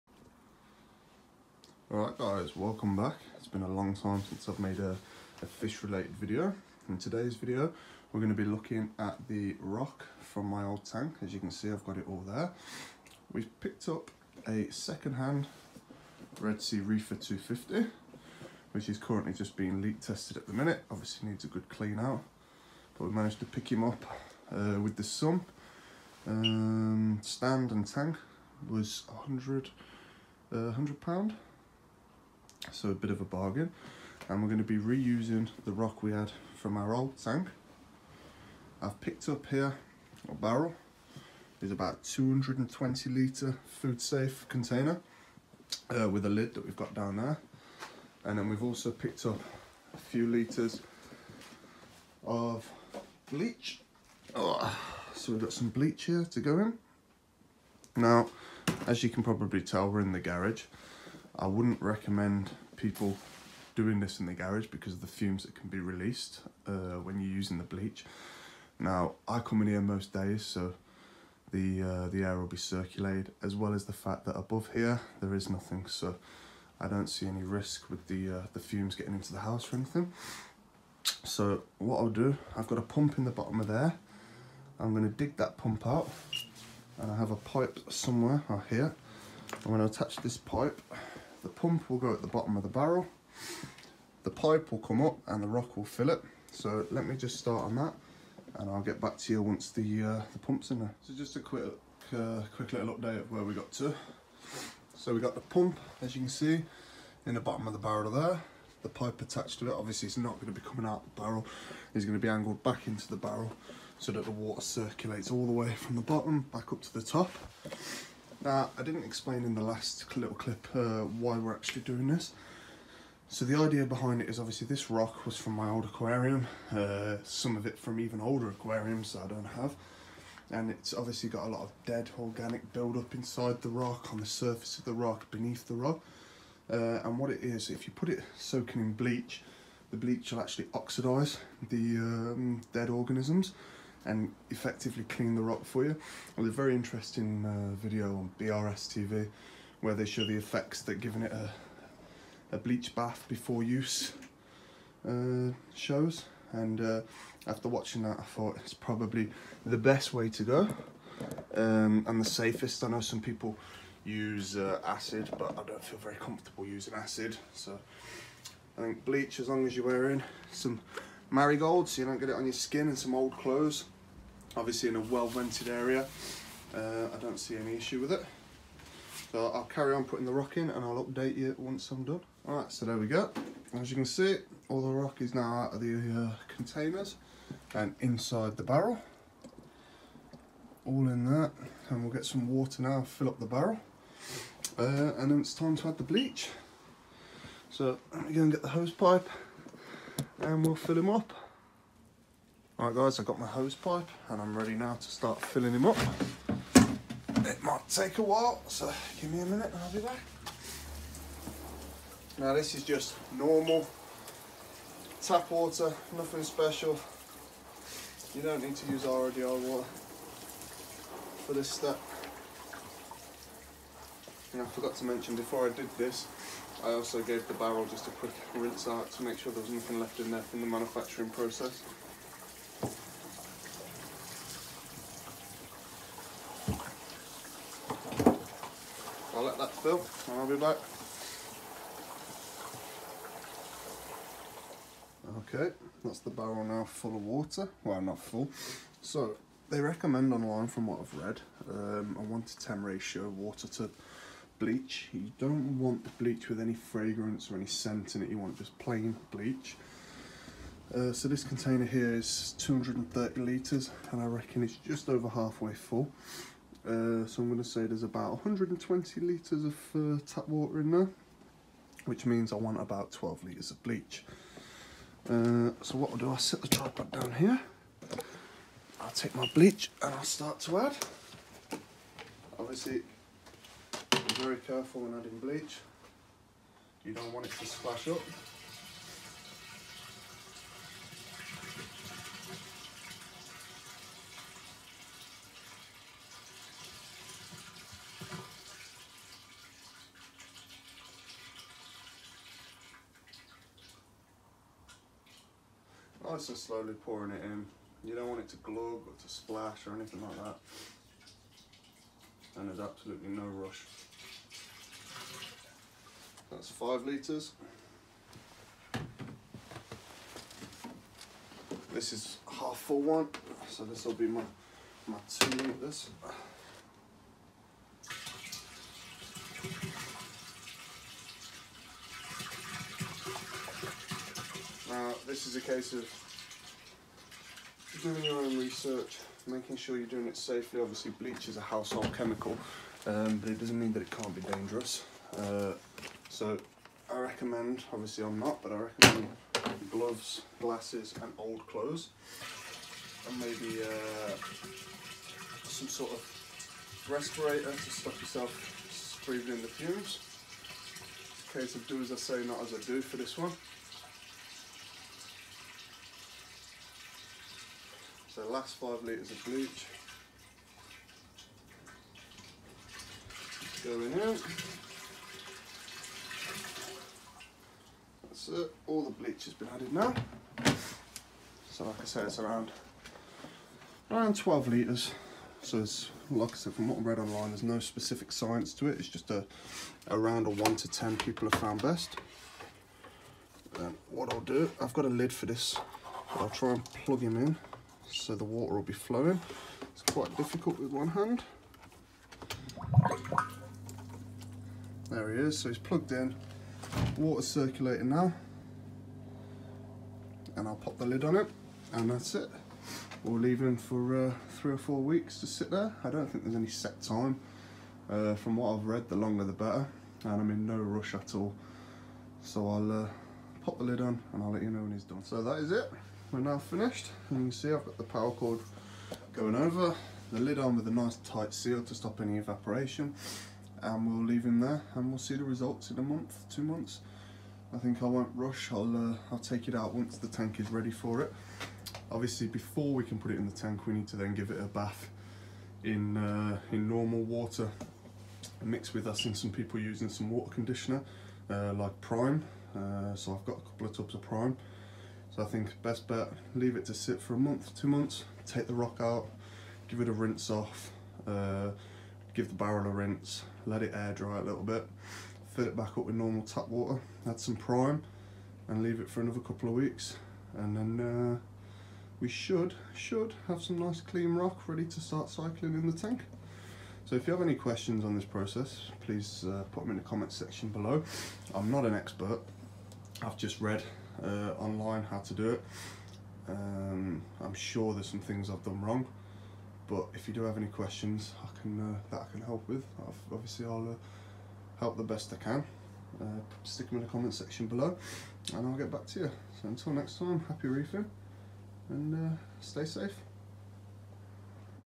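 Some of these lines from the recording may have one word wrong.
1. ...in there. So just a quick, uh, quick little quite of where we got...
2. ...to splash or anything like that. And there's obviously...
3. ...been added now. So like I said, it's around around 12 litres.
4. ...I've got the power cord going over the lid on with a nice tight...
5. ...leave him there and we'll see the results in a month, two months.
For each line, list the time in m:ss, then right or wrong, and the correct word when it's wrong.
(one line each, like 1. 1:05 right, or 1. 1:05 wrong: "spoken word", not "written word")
1. 1:40 wrong: "update", not "quite"
2. 5:09 wrong: "absolutely", not "obviously"
3. 6:19 right
4. 7:07 right
5. 7:14 right.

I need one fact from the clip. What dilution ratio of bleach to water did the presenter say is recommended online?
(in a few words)
1 to 10.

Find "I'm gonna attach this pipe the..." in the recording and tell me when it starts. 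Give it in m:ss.
1:29.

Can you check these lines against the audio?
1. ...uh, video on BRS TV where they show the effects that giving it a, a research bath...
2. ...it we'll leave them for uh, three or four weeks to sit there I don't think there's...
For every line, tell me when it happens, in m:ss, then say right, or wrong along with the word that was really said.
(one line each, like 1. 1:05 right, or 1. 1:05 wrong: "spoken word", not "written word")
1. 2:27 wrong: "bleach", not "research"
2. 6:52 right.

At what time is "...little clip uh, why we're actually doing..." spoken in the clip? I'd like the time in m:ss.
2:00.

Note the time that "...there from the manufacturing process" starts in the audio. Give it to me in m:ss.
3:50.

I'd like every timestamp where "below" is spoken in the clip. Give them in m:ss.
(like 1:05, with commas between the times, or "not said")
8:00, 8:17.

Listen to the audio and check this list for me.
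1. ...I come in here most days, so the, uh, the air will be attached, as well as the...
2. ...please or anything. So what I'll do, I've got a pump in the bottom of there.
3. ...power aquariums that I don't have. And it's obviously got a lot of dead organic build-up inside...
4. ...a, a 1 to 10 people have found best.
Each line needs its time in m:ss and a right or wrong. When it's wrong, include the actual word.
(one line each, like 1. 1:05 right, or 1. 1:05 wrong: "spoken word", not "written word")
1. 1:09 wrong: "circulated", not "attached"
2. 1:19 wrong: "house", not "please"
3. 2:08 wrong: "older", not "power"
4. 6:29 right.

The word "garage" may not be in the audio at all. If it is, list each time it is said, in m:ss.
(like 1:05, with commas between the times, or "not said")
1:00, 1:04.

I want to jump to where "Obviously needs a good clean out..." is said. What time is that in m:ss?
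0:20.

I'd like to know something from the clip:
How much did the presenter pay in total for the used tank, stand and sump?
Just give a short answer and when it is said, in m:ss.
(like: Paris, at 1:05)
100 pounds, at 0:30.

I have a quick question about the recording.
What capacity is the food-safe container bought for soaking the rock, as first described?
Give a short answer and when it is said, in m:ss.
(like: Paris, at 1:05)
220 litres, at 0:42.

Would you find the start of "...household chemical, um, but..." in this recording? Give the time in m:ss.
5:41.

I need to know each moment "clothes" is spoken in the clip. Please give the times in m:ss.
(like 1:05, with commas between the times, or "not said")
2:53, 5:51.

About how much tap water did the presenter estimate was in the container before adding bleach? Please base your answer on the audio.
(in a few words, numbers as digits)
120 litres.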